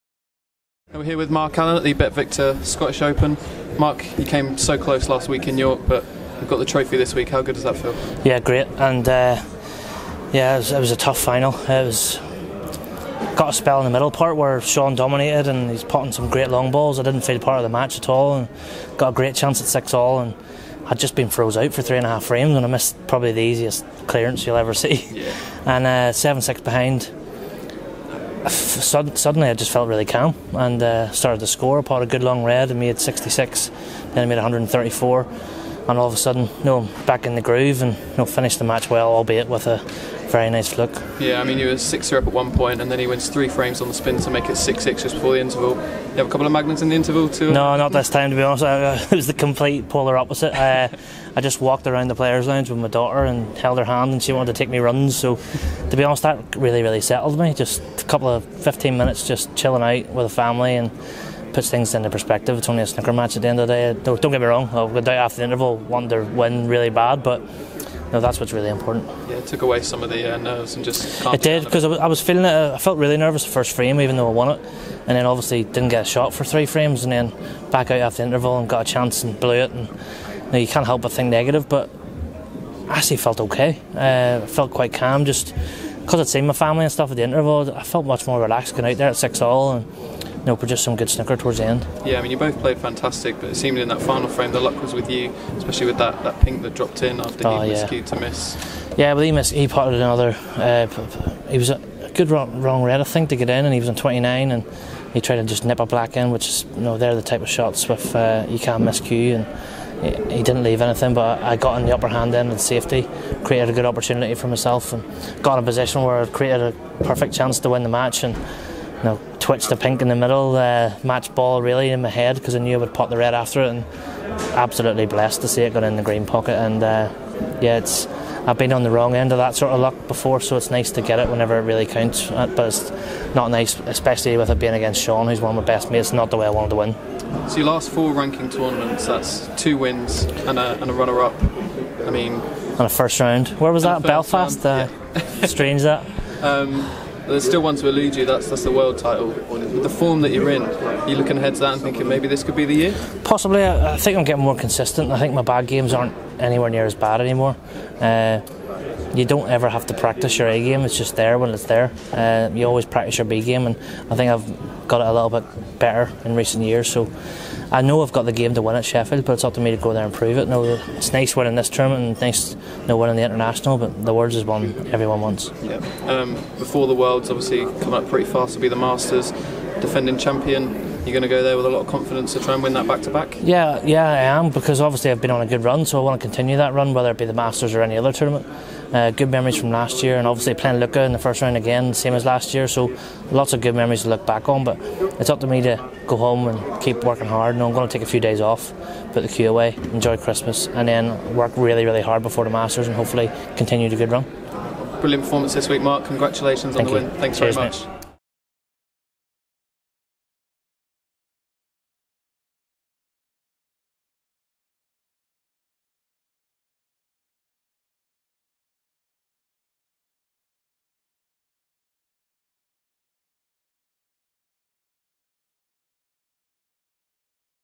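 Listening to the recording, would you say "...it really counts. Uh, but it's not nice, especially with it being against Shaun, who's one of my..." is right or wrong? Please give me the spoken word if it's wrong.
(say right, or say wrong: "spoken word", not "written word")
right.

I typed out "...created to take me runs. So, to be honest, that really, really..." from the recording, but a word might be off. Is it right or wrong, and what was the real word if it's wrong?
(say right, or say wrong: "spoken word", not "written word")
wrong: "wanted", not "created".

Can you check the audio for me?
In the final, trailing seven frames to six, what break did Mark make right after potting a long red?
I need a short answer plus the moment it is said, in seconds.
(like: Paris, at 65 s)
66, at 32 s.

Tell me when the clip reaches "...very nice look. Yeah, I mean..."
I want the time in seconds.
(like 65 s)
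40 s.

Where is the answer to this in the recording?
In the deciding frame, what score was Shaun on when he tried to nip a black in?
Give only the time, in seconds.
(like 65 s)
103 s.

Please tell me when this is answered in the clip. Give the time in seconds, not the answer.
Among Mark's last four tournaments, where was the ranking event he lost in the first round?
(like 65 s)
144 s.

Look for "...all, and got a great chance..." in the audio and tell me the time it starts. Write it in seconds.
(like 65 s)
18 s.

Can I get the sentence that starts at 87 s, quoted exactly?
I felt much more relaxed going out there at six all and no, but just some good snooker towards the end.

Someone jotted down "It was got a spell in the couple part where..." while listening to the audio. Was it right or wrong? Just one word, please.
wrong.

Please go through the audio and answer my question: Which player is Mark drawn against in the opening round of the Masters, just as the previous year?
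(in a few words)
Luca.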